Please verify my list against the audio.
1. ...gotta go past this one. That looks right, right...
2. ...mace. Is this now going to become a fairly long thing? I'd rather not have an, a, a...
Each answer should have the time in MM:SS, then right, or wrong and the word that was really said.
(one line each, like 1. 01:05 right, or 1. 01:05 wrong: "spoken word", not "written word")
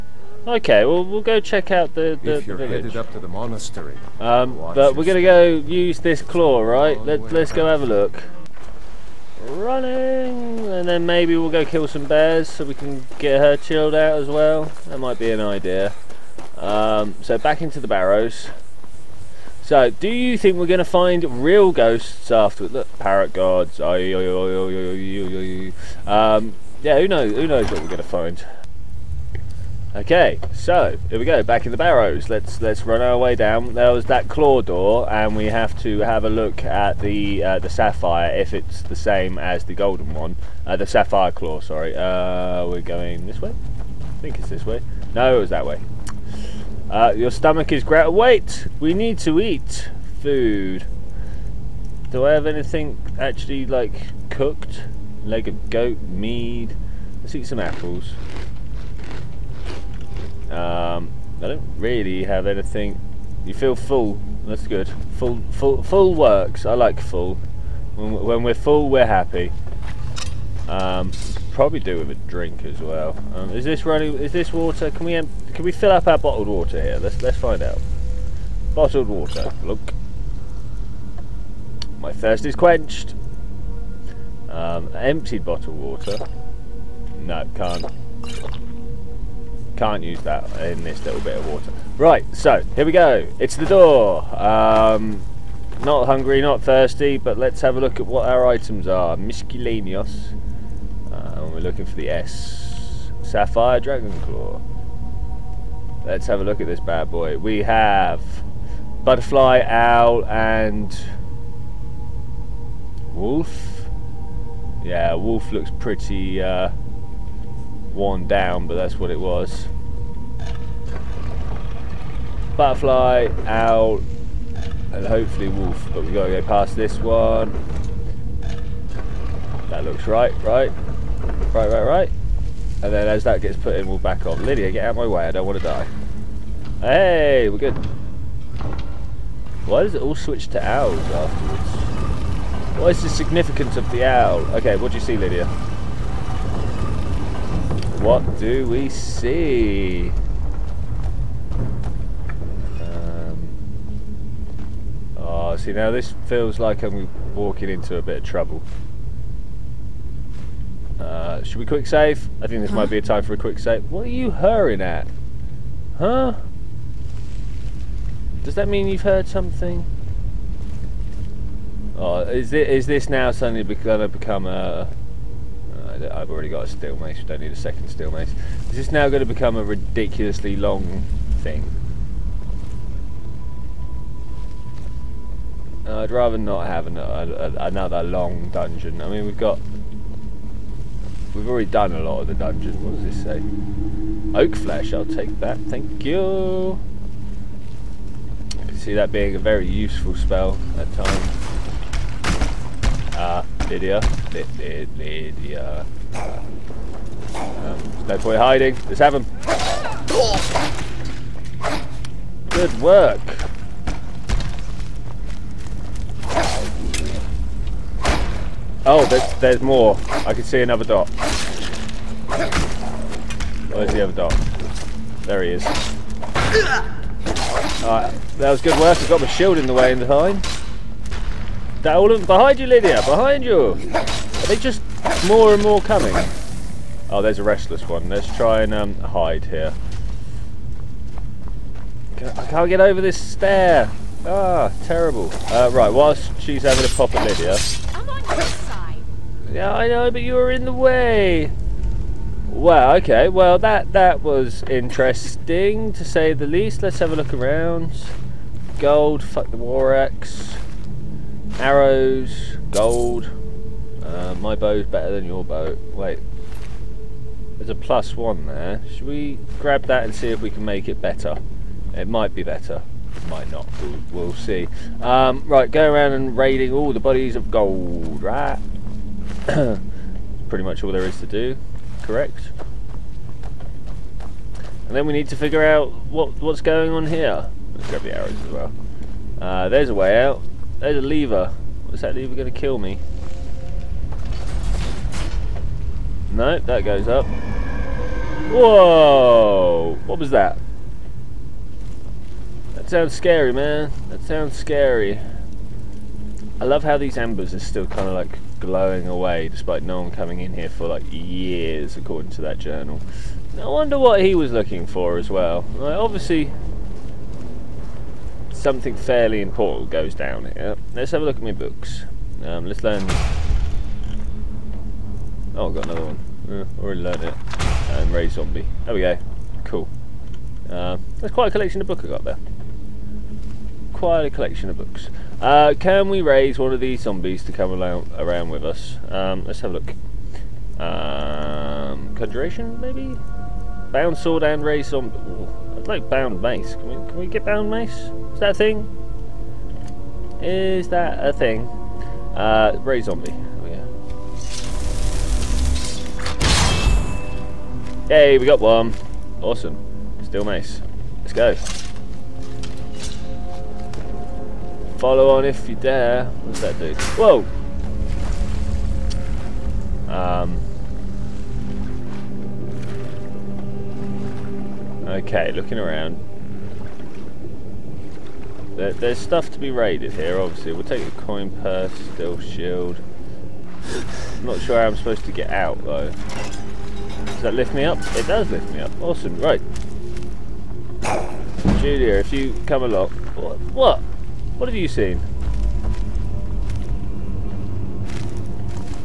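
1. 02:06 right
2. 02:58 wrong: "ridiculously", not "fairly".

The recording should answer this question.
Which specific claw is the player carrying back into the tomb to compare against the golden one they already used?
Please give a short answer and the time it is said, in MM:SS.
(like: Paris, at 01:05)
Sapphire Dragon Claw, at 01:43.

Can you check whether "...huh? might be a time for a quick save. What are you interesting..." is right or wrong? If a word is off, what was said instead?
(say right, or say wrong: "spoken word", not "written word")
wrong: "hurrying", not "interesting".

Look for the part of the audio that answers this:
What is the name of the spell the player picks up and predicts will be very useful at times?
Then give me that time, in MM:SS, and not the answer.
03:14.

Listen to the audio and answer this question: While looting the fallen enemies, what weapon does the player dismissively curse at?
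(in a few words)
war axe.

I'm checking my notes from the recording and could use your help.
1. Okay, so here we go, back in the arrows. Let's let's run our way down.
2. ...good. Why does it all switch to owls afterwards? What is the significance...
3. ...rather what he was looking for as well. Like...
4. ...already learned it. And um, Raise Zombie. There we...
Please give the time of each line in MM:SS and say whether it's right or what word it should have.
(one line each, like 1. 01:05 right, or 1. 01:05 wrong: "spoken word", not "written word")
1. 00:29 wrong: "barrows", not "arrows"
2. 02:17 right
3. 05:13 wrong: "wonder", not "rather"
4. 05:26 right.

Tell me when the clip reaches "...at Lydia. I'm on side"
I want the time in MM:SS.
04:07.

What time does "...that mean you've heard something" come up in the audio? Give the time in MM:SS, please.
02:48.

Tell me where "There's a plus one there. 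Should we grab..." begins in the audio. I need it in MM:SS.
04:27.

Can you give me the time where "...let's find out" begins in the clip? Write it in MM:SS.
01:17.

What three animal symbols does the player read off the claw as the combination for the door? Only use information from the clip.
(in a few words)
butterfly, owl, and wolf.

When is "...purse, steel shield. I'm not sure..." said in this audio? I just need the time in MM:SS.
06:21.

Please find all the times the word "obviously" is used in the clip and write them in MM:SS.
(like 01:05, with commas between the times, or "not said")
05:15, 06:20.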